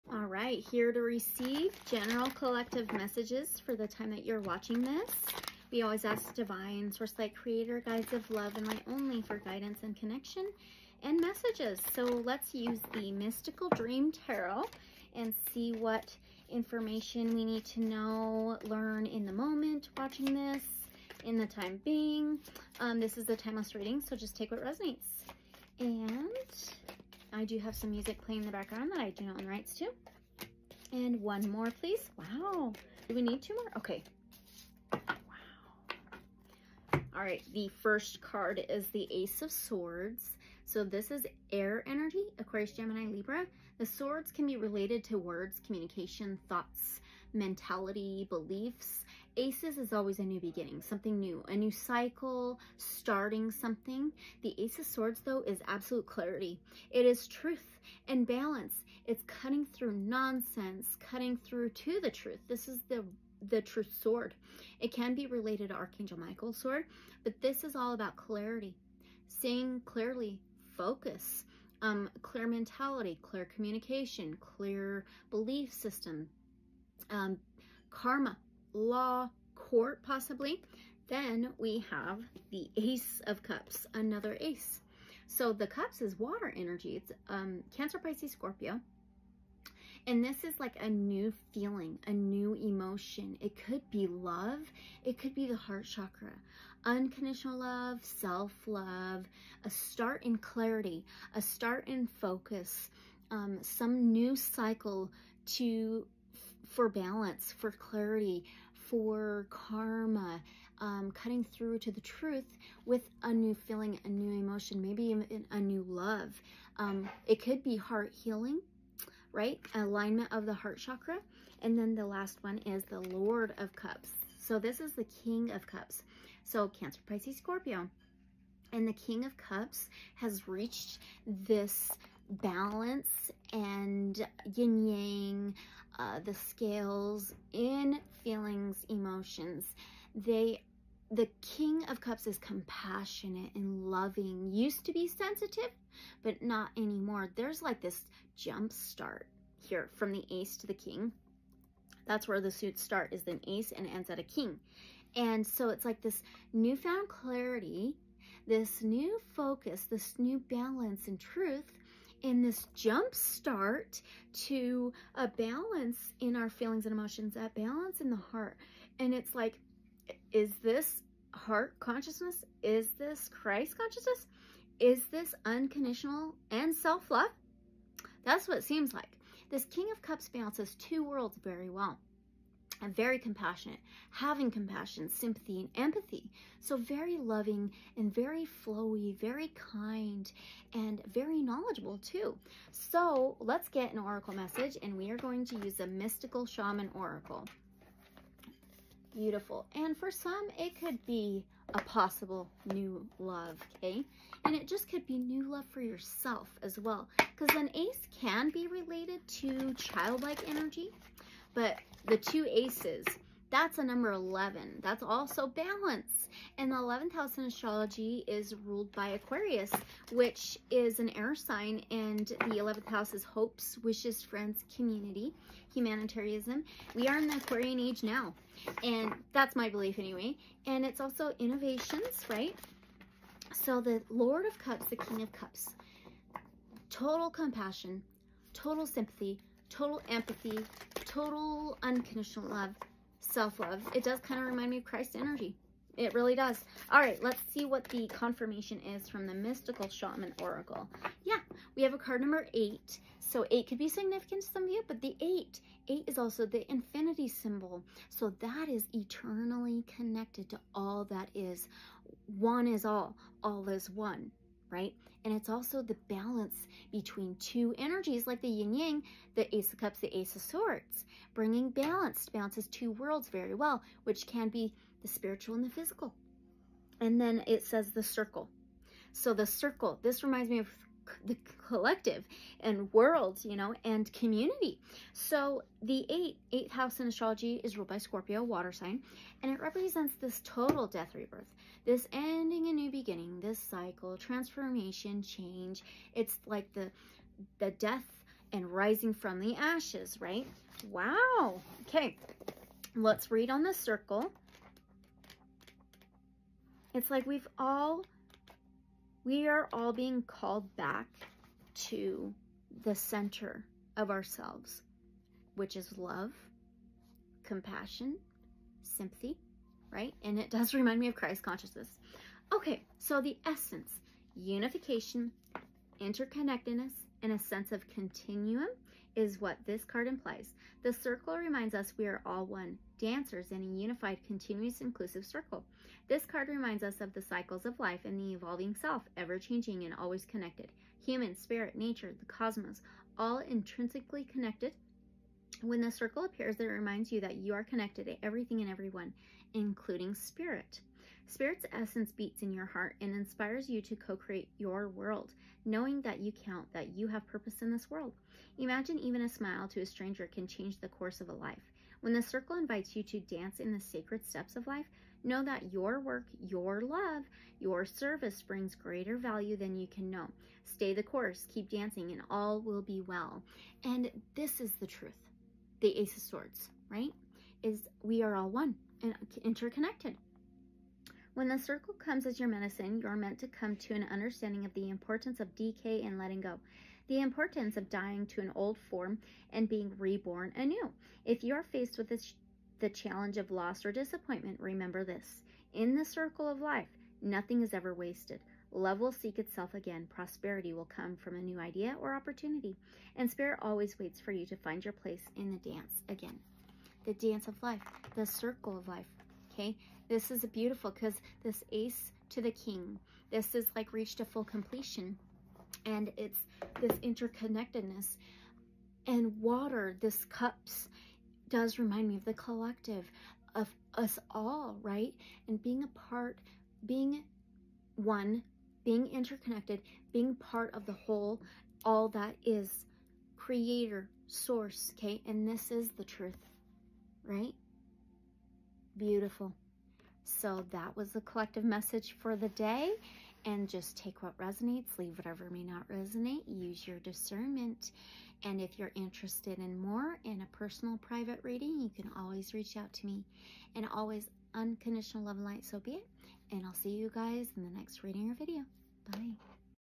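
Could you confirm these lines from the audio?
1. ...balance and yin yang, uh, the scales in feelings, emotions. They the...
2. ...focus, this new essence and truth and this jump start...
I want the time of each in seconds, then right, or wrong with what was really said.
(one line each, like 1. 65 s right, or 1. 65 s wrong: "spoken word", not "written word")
1. 132 s right
2. 159 s wrong: "balance", not "essence".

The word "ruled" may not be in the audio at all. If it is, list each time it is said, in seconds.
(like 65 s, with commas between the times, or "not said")
218 s, 287 s.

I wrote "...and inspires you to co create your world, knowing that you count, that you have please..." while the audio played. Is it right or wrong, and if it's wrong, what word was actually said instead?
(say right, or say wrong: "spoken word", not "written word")
wrong: "purpose", not "please".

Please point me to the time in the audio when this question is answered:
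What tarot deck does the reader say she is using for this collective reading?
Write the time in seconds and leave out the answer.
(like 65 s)
13 s.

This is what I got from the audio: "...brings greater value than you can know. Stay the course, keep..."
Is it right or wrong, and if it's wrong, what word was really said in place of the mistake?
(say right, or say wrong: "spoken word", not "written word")
right.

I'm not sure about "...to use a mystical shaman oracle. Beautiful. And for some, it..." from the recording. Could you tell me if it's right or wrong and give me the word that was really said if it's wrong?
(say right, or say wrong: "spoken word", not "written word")
right.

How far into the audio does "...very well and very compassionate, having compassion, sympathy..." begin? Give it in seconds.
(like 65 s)
181 s.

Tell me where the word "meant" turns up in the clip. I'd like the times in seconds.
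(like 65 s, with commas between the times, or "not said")
383 s.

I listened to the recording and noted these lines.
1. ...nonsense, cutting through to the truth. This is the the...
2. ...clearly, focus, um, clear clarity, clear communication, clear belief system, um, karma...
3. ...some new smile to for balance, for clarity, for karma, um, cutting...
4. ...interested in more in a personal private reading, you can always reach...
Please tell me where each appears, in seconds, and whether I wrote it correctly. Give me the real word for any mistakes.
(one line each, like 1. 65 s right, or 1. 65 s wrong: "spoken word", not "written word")
1. 59 s right
2. 69 s wrong: "mentality", not "clarity"
3. 103 s wrong: "cycle", not "smile"
4. 448 s right.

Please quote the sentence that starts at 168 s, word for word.
And it's like, is this heart consciousness?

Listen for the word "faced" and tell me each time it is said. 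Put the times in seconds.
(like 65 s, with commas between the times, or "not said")
391 s.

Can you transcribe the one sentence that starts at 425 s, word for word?
And being a part, being one, being interconnected, being part of the whole, all that is creator, source, okay?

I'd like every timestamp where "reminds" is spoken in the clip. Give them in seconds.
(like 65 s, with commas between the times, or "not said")
244 s, 280 s, 320 s, 331 s, 336 s, 346 s, 421 s.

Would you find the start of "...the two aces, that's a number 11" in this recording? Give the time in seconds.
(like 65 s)
212 s.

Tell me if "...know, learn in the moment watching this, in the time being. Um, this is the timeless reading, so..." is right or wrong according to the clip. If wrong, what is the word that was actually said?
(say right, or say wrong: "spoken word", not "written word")
right.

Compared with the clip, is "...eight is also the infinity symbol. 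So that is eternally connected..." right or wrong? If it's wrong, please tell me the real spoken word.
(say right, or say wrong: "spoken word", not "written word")
right.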